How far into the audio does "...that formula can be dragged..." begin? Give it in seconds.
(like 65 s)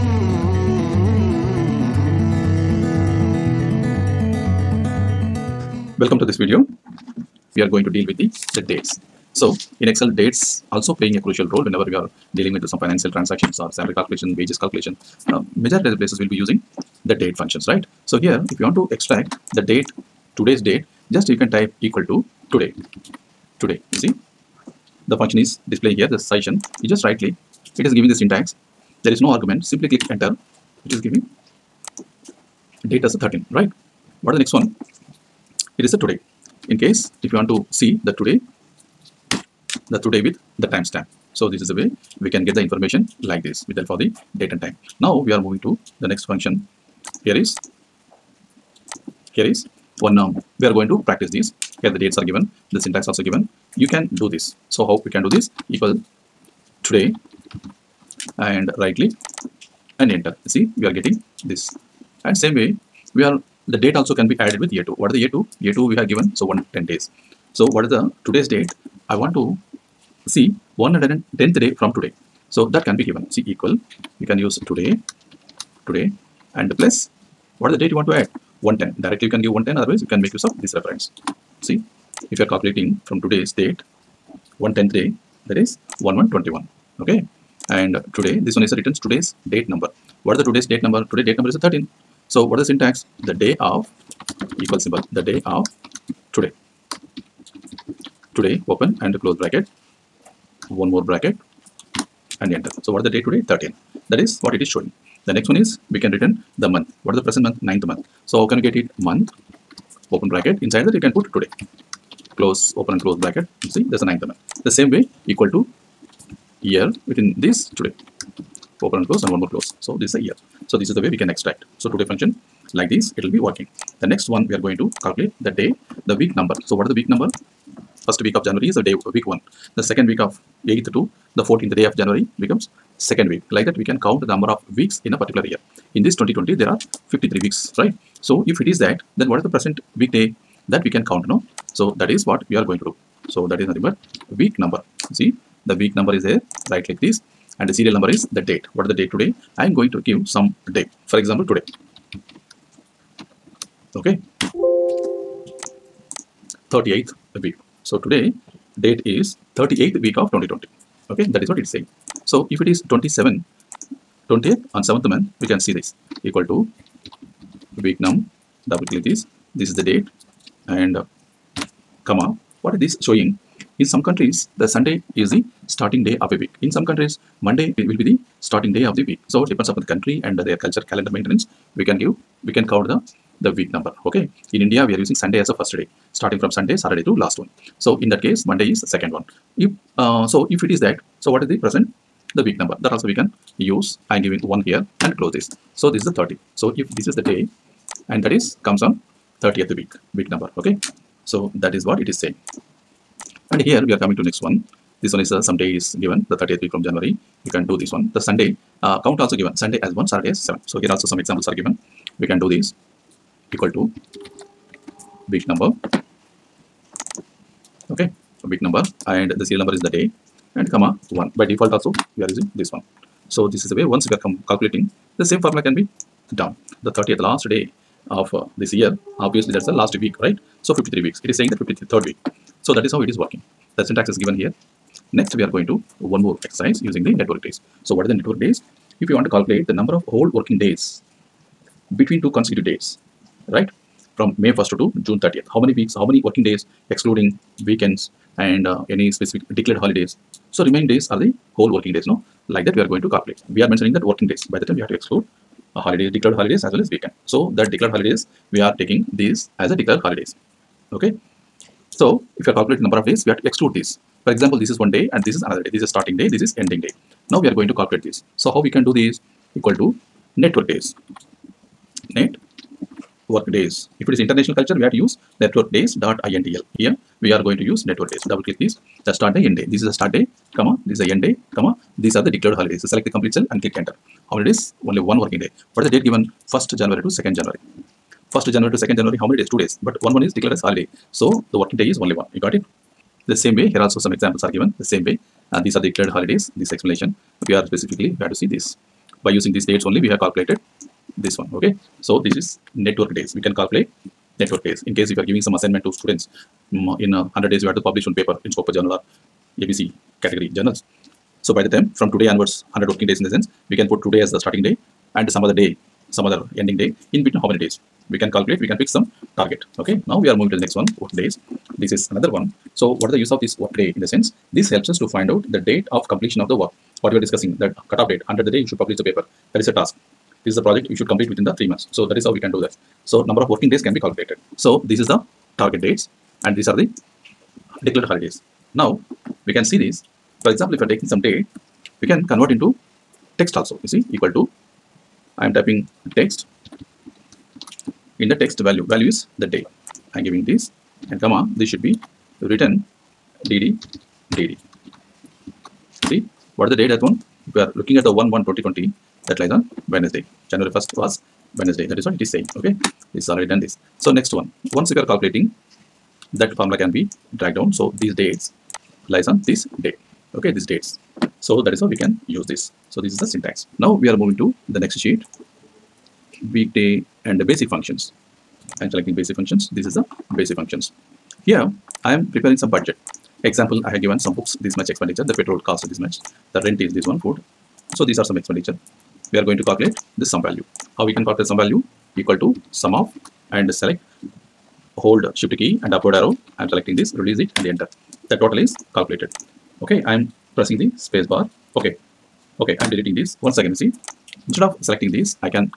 366 s.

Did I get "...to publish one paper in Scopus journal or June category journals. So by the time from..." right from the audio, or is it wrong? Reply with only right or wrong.
wrong.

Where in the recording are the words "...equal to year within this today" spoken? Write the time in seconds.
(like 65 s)
115 s.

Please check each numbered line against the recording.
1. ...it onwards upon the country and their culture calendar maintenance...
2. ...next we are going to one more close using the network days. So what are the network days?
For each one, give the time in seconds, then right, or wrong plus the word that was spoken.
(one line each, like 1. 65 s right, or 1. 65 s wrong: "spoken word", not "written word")
1. 179 s wrong: "depends", not "onwards"
2. 235 s wrong: "exercise", not "close".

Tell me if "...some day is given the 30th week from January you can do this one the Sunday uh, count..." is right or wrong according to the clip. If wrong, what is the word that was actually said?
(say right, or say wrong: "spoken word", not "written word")
right.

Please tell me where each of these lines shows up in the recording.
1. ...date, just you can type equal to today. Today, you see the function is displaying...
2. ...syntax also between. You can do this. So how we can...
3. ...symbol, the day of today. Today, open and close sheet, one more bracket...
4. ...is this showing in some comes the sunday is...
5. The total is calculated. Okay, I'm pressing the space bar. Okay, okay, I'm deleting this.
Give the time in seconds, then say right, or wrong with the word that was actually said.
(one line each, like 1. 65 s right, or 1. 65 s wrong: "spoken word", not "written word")
1. 20 s right
2. 52 s wrong: "given", not "between"
3. 94 s wrong: "bracket", not "sheet"
4. 172 s wrong: "countries", not "comes"
5. 398 s right.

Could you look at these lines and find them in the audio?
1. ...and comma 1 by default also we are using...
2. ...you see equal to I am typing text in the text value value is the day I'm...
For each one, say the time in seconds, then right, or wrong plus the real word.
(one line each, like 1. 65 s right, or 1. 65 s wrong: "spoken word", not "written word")
1. 220 s right
2. 343 s right.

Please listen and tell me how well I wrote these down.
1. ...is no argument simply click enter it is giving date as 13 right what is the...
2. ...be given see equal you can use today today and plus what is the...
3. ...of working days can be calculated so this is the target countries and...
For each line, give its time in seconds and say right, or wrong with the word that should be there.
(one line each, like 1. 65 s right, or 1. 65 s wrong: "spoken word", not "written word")
1. 29 s right
2. 72 s right
3. 333 s wrong: "dates", not "countries".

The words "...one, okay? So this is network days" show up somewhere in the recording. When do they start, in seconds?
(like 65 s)
301 s.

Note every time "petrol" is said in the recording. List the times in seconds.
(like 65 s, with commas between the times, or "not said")
385 s.